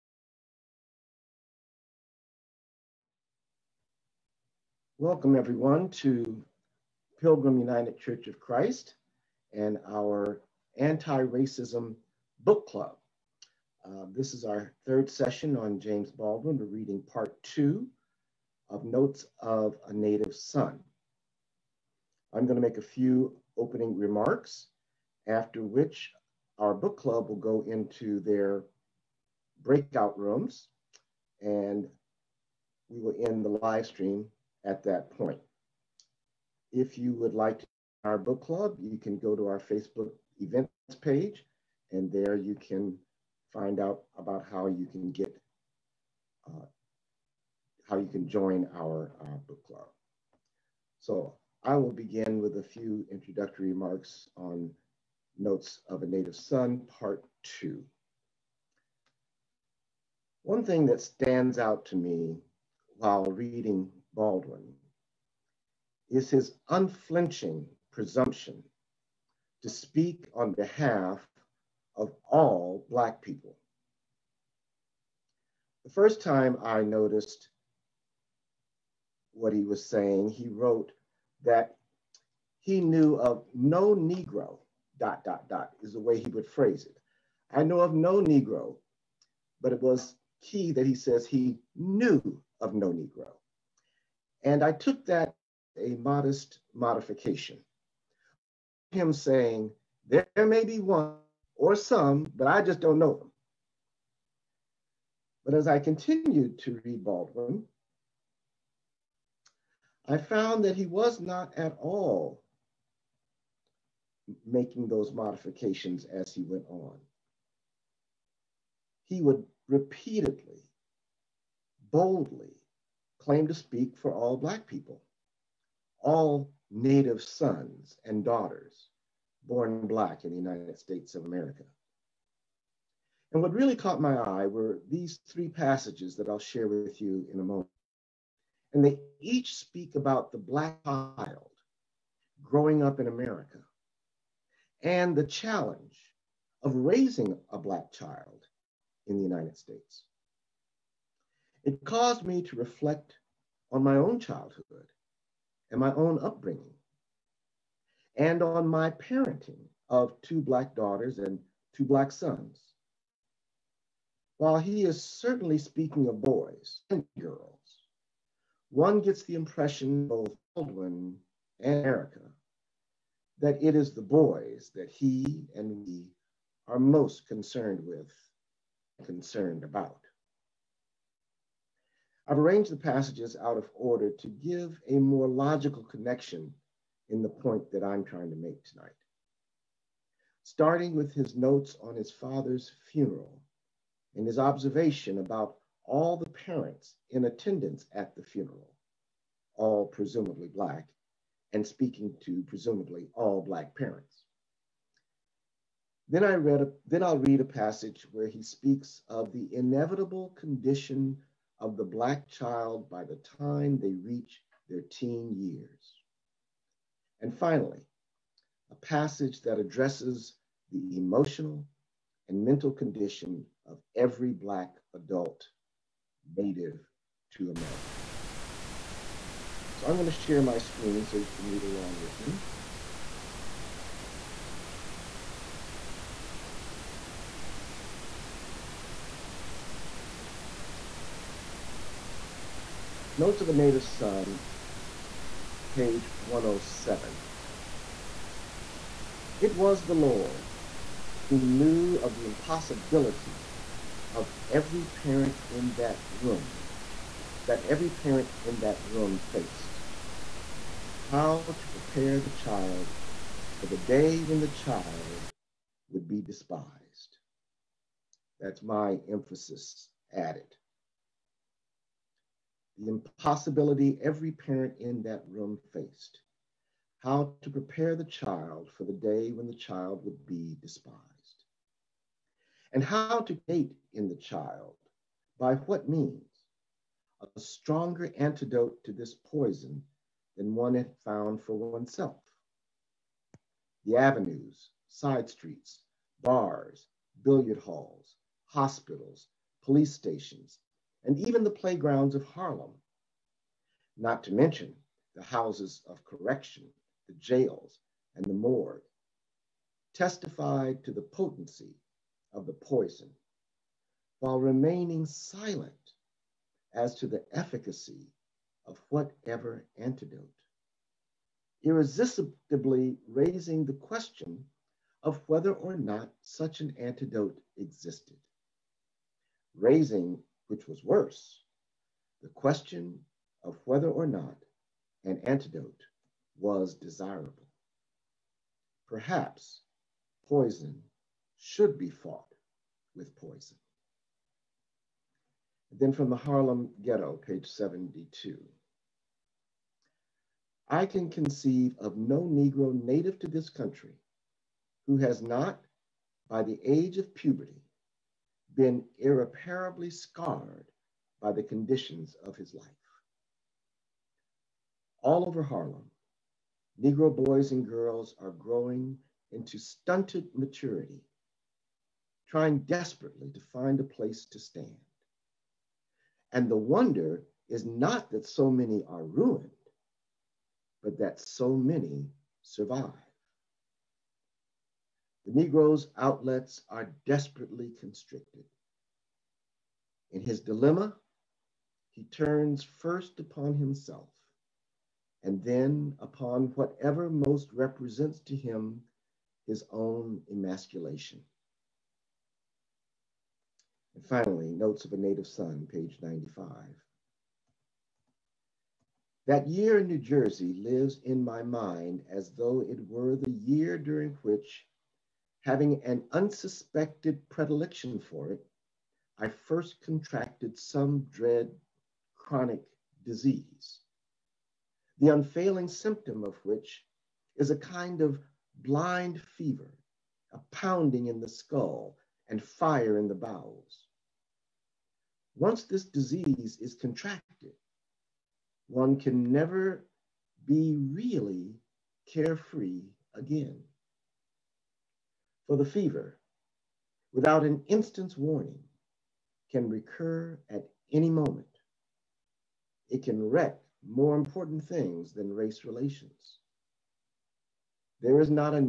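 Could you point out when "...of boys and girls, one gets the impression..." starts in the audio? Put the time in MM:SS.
02:46.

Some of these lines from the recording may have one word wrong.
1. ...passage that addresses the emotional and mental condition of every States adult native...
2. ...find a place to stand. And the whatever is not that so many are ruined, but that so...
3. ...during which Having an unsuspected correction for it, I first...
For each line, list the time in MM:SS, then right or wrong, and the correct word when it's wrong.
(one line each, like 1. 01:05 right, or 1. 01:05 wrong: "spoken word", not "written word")
1. 03:38 wrong: "Black", not "States"
2. 06:13 wrong: "wonder", not "whatever"
3. 06:53 wrong: "predilection", not "correction".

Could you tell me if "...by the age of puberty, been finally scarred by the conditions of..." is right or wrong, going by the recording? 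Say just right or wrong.
wrong.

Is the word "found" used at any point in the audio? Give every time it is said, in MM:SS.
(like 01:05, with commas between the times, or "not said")
01:50, 04:51.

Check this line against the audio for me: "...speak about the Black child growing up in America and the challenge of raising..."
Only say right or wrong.
right.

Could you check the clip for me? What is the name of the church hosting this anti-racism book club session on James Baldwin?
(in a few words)
Pilgrim United Church of Christ.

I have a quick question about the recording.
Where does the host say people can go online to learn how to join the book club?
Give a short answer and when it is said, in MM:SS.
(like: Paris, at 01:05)
Facebook events page, at 00:39.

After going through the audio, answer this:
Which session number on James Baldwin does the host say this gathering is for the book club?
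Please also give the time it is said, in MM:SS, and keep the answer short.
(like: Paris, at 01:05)
third, at 00:14.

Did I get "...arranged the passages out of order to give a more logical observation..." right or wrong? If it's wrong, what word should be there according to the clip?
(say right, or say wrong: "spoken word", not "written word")
wrong: "connection", not "observation".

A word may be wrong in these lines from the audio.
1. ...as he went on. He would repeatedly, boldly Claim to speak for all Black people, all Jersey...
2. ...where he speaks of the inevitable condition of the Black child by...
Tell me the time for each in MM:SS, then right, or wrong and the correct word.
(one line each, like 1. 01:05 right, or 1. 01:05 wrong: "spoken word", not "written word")
1. 01:56 wrong: "Native", not "Jersey"
2. 03:28 right.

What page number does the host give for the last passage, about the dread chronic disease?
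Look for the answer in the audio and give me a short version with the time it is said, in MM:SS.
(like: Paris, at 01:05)
95, at 06:45.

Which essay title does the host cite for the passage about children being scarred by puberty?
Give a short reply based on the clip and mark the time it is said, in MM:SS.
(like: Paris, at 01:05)
The Harlem Ghetto, at 05:46.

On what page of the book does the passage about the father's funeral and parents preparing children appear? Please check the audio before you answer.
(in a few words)
107.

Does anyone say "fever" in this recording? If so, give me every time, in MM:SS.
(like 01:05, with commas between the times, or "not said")
07:09, 07:25.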